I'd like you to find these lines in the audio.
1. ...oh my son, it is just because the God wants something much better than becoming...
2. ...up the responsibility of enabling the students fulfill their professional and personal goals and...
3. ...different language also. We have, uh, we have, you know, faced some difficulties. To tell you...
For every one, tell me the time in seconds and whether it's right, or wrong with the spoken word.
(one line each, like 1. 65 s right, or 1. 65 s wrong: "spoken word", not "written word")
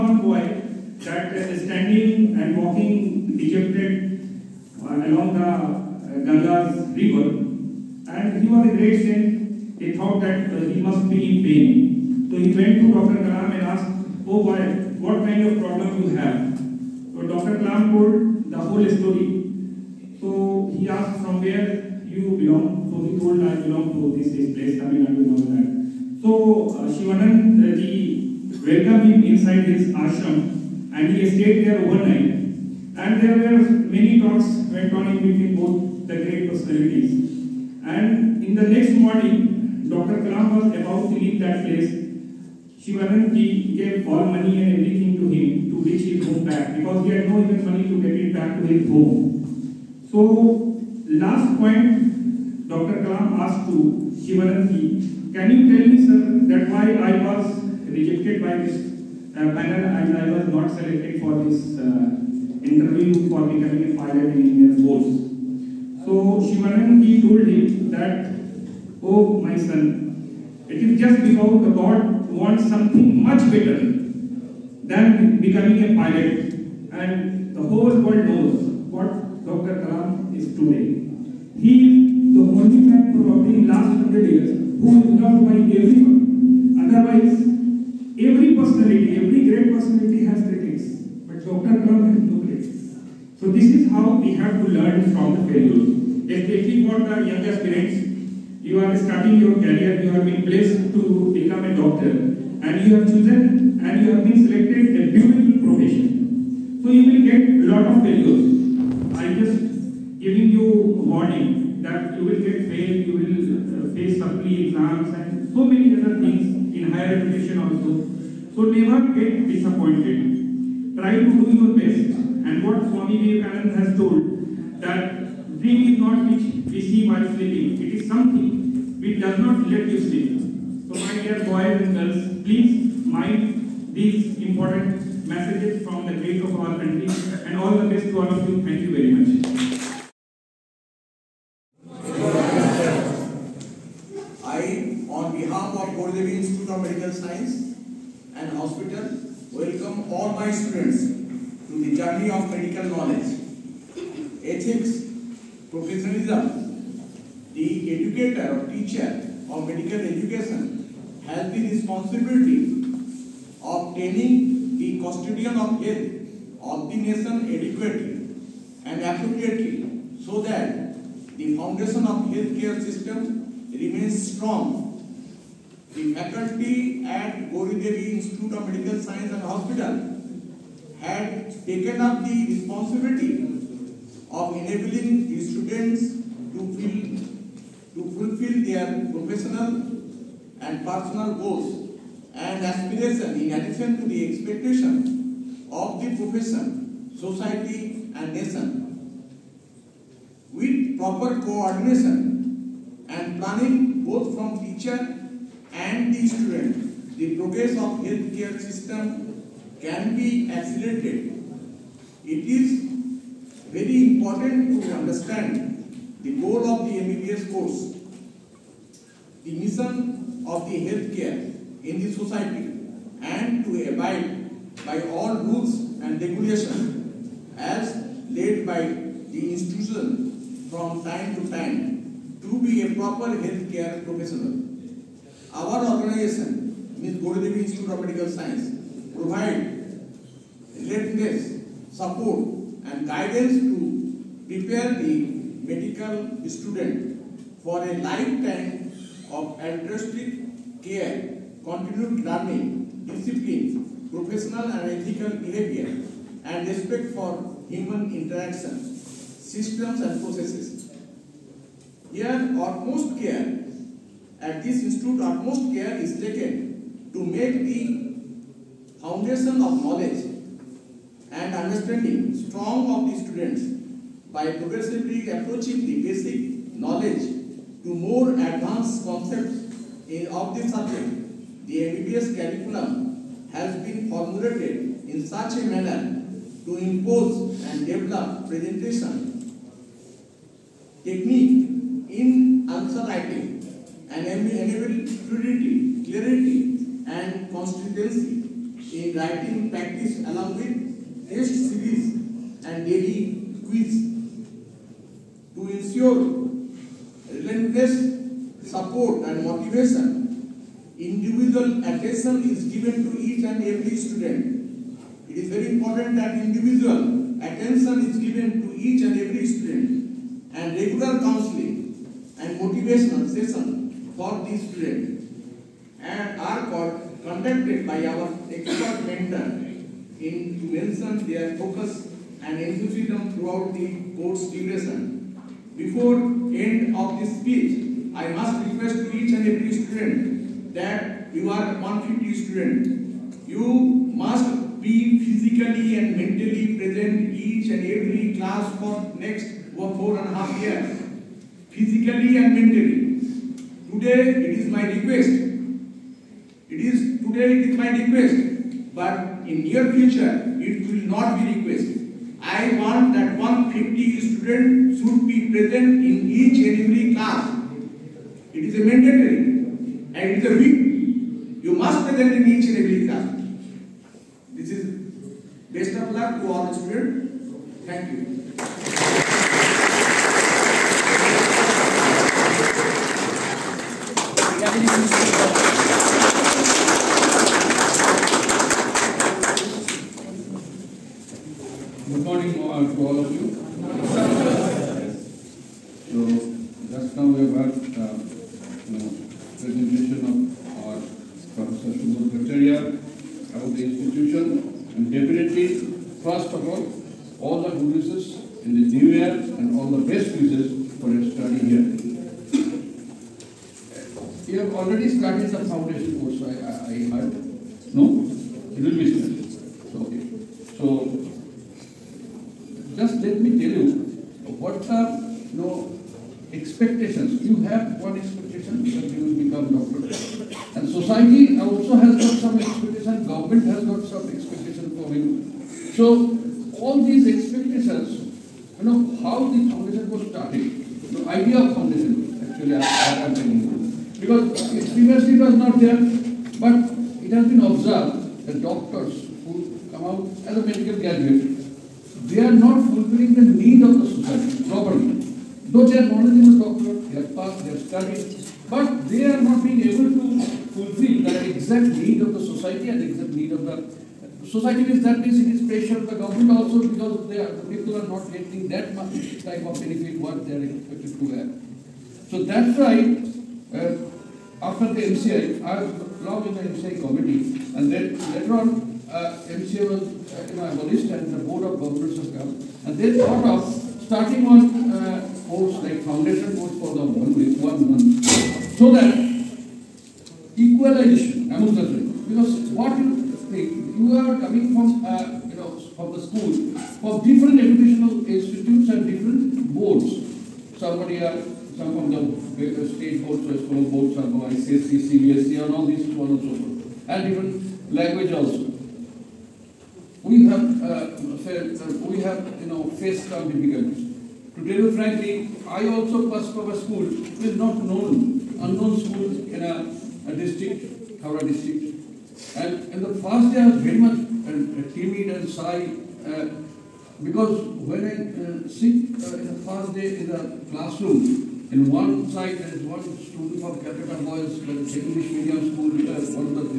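1. 69 s right
2. 182 s right
3. 507 s right.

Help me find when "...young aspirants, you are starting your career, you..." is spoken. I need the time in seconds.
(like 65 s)
97 s.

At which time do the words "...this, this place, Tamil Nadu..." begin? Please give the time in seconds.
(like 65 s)
24 s.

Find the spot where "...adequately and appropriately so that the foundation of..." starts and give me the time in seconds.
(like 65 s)
167 s.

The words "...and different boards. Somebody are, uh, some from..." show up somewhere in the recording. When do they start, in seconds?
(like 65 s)
498 s.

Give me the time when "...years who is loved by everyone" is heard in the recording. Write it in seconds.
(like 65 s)
84 s.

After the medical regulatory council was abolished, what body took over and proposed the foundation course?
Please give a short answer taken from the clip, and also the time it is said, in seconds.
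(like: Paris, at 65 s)
board of governors, at 481 s.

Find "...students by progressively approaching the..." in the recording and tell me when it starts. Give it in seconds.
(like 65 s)
273 s.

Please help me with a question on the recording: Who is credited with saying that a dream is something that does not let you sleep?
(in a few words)
Swami Vivekananda.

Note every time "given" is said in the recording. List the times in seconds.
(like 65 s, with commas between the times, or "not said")
312 s, 318 s.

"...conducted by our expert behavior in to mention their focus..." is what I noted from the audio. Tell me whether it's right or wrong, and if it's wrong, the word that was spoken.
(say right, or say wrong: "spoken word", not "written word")
wrong: "mentor", not "behavior".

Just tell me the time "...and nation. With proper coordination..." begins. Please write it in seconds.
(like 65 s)
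198 s.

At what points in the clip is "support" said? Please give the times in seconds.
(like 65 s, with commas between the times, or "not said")
241 s, 307 s.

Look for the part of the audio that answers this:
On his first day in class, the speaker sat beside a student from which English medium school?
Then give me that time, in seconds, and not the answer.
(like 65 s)
533 s.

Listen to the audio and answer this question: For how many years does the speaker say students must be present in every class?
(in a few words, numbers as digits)
four and a half.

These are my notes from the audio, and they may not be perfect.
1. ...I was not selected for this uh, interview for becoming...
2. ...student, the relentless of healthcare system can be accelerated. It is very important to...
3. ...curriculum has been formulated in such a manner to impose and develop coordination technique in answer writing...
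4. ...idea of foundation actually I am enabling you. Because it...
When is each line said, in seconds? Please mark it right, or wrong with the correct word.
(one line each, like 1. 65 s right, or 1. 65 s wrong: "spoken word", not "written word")
1. 60 s right
2. 206 s wrong: "progress", not "relentless"
3. 282 s wrong: "presentation", not "coordination"
4. 441 s wrong: "telling", not "enabling".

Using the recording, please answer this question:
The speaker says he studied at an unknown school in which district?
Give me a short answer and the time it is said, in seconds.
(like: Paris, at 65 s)
Howrah, at 521 s.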